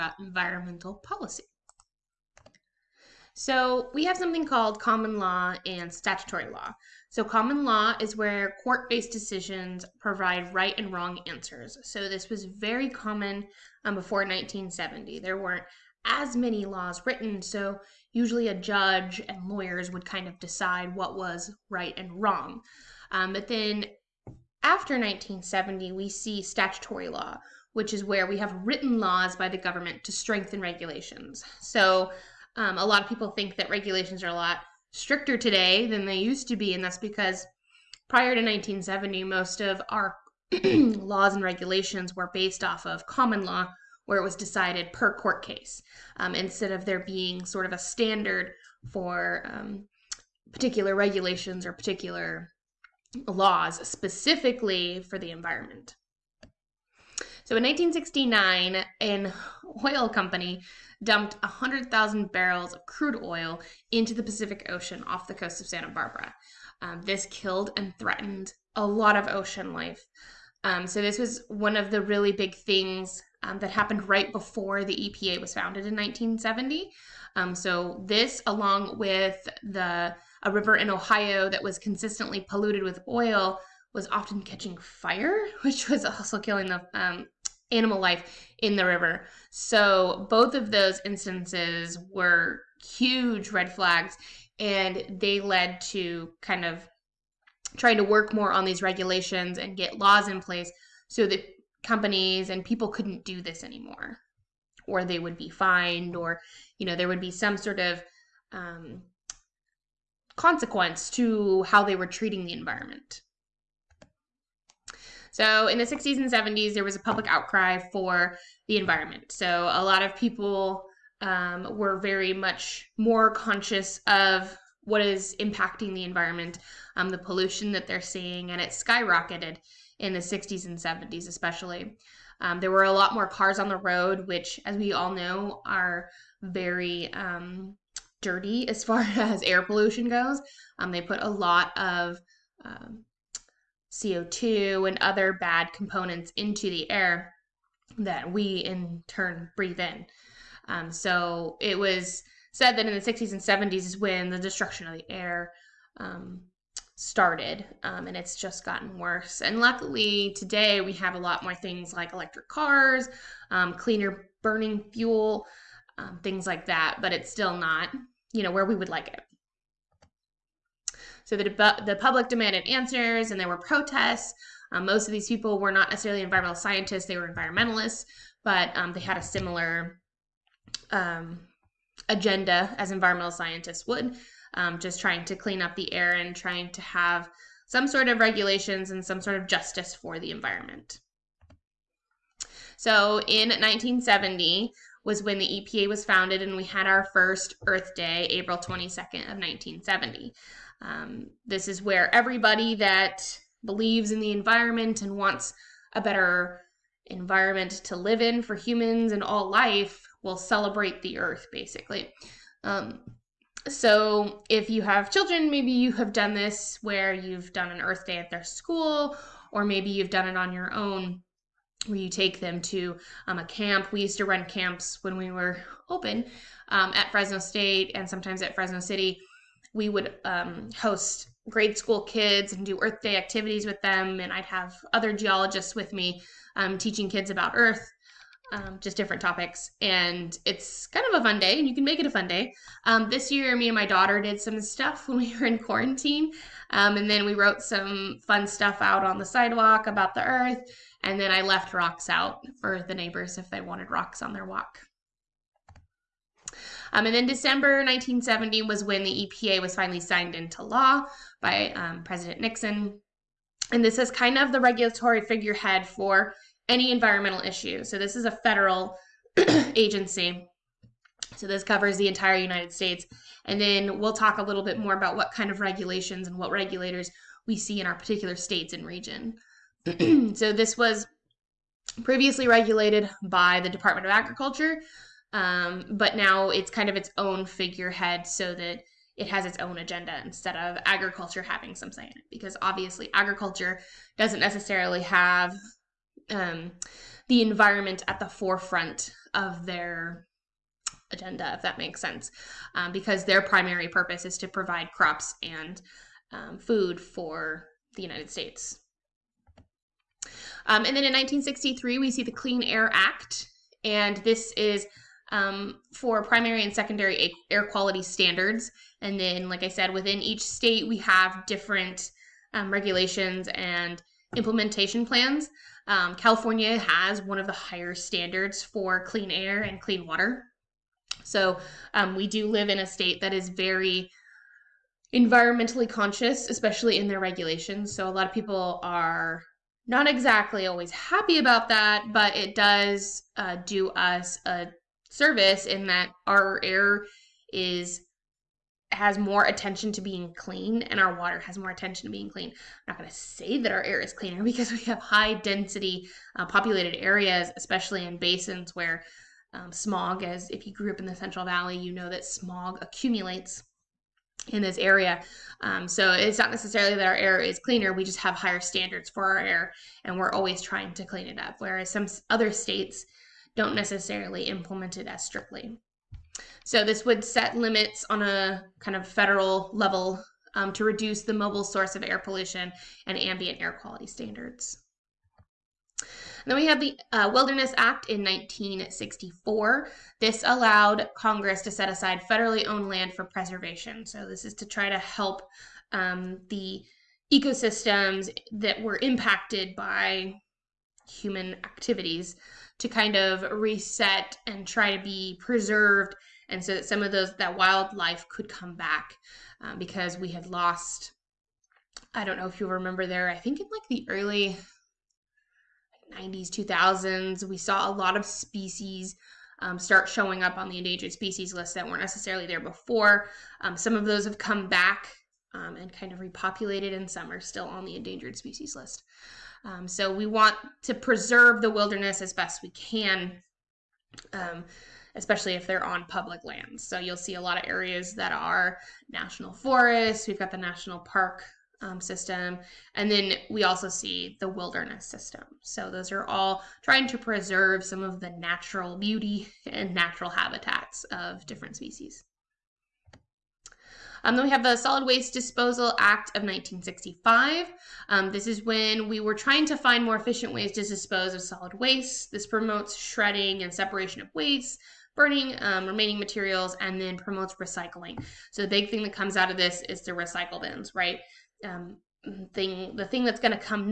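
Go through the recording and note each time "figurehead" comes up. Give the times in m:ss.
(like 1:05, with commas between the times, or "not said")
4:25, 4:47.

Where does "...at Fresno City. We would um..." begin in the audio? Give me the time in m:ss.
3:48.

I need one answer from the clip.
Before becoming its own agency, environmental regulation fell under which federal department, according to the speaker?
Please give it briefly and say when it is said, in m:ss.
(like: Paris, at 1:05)
Department of Agriculture, at 4:43.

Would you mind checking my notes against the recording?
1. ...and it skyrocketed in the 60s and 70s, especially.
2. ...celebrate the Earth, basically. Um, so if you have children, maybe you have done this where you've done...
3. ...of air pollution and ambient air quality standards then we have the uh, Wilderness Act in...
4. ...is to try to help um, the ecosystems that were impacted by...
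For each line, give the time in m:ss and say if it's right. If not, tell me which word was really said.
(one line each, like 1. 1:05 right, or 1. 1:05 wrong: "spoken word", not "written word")
1. 2:08 right
2. 3:30 right
3. 6:21 right
4. 6:34 right.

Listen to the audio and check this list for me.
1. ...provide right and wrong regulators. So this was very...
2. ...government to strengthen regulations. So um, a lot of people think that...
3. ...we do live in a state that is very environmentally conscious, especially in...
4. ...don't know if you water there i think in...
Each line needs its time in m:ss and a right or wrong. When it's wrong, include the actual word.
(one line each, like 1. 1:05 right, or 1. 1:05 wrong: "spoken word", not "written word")
1. 0:09 wrong: "answers", not "regulators"
2. 0:29 right
3. 5:32 right
4. 6:52 wrong: "remember", not "water".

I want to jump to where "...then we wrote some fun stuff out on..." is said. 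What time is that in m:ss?
4:07.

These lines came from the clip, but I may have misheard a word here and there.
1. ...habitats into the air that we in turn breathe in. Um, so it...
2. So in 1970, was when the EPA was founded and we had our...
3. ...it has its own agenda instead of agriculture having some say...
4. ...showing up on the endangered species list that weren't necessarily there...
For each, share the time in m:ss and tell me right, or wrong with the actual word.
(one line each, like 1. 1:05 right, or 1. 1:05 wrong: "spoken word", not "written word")
1. 2:25 wrong: "components", not "habitats"
2. 3:12 right
3. 4:49 right
4. 7:00 right.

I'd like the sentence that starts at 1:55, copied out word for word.
So in the 60s and 70s, there was a public outcry for the environment.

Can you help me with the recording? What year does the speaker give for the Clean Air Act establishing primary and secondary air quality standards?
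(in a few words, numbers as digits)
1963.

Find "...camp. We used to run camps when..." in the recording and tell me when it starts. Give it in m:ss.
3:43.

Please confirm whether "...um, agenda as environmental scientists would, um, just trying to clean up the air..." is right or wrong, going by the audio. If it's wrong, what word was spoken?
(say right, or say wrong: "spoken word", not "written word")
right.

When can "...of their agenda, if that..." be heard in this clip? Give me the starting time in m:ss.
4:59.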